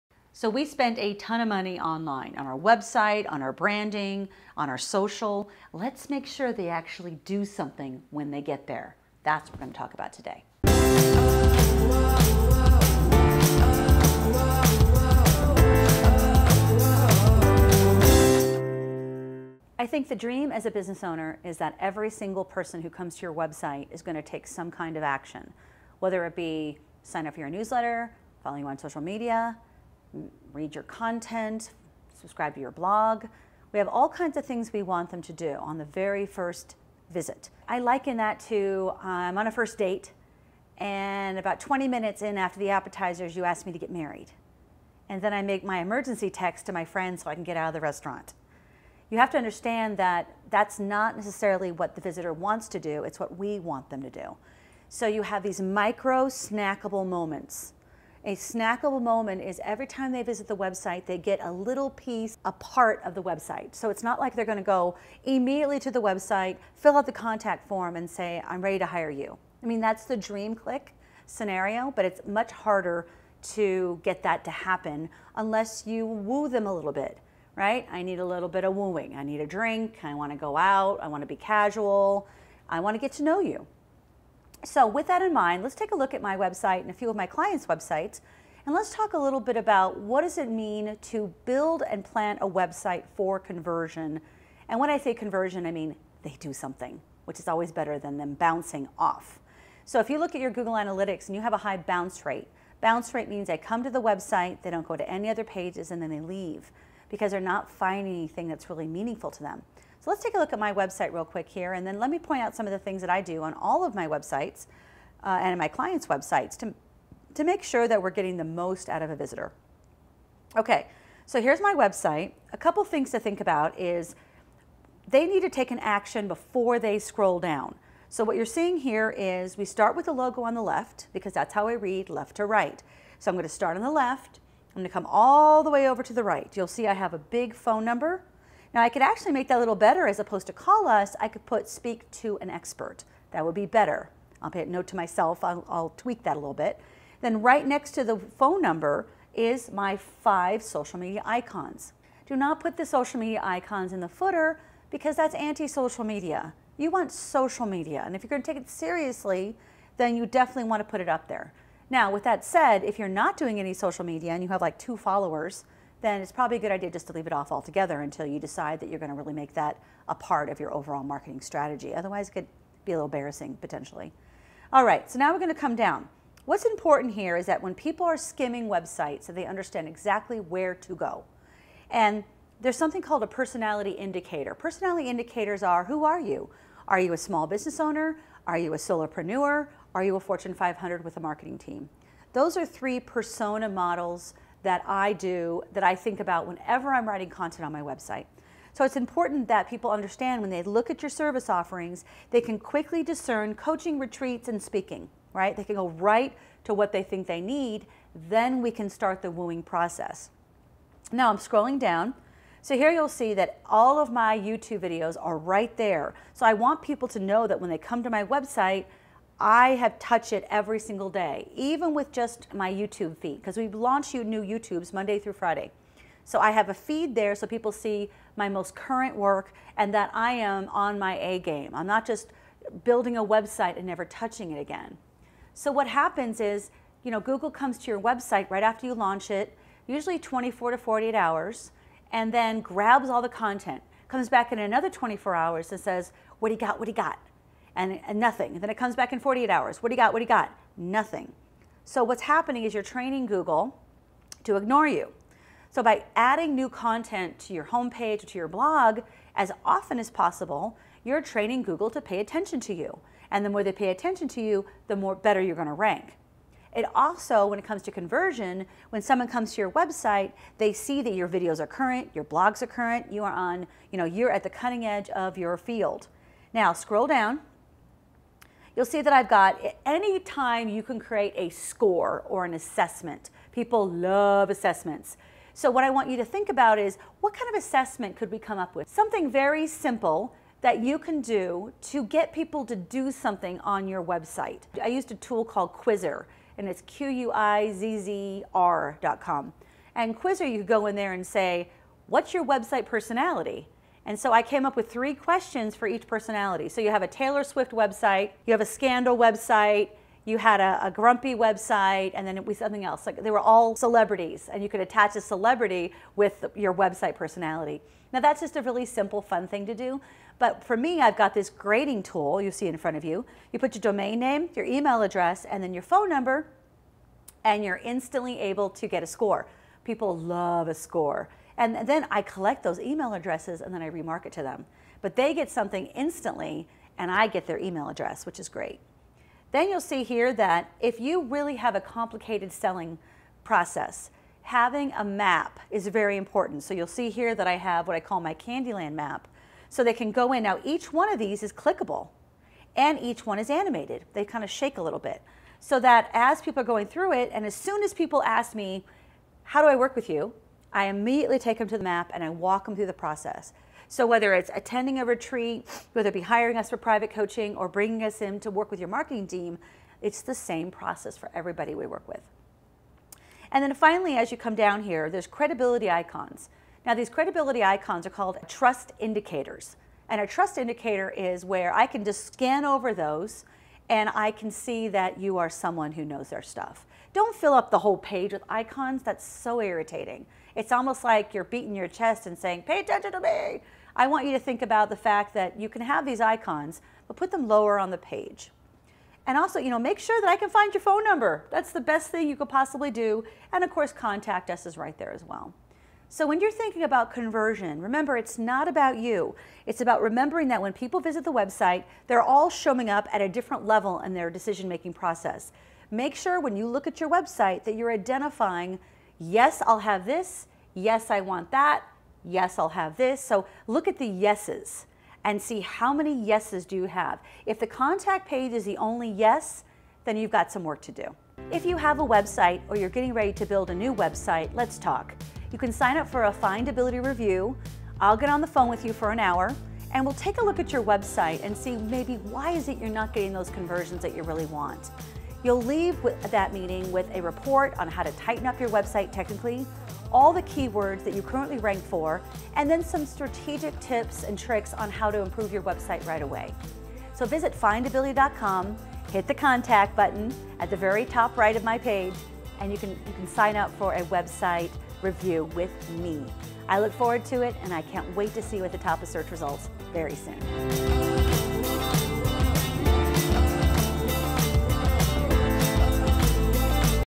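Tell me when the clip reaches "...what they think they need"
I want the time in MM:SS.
03:26.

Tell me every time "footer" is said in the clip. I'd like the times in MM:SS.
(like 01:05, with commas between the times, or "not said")
02:34.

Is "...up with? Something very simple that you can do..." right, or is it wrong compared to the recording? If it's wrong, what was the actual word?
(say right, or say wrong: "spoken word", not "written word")
right.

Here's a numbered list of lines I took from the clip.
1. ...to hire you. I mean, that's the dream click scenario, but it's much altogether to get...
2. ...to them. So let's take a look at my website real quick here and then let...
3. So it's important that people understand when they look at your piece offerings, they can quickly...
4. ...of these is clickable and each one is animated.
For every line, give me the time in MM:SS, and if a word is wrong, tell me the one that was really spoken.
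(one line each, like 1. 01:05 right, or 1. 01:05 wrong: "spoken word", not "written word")
1. 01:08 wrong: "harder", not "altogether"
2. 01:49 right
3. 03:18 wrong: "service", not "piece"
4. 05:51 right.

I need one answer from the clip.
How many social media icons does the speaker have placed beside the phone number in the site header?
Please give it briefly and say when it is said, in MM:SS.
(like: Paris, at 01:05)
5, at 02:29.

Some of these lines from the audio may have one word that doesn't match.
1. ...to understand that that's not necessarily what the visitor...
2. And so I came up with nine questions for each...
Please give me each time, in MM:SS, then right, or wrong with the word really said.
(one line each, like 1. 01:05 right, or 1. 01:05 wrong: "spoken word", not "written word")
1. 00:49 right
2. 05:04 wrong: "three", not "nine".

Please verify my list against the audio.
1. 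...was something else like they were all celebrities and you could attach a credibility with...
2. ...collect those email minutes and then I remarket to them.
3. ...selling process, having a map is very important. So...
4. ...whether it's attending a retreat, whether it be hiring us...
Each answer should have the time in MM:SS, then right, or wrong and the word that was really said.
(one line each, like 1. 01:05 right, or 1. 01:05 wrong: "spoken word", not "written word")
1. 05:12 wrong: "celebrity", not "credibility"
2. 05:32 wrong: "addresses", not "minutes"
3. 05:42 right
4. 06:04 right.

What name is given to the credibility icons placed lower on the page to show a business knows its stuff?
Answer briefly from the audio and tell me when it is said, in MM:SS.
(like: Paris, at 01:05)
Trust indicators, at 06:18.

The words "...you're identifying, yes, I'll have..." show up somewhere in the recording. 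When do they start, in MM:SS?
06:57.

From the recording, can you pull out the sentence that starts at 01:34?
And when I say conversion, I mean they do something, which is always better than them bouncing off.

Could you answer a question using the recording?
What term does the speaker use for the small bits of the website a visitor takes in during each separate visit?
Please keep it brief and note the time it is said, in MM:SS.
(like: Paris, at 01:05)
Snackable moment, at 00:58.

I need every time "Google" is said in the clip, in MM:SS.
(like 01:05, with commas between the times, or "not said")
01:40, 03:57, 04:13, 04:21.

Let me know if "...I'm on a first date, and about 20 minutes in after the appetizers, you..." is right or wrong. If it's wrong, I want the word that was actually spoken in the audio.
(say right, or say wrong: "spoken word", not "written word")
right.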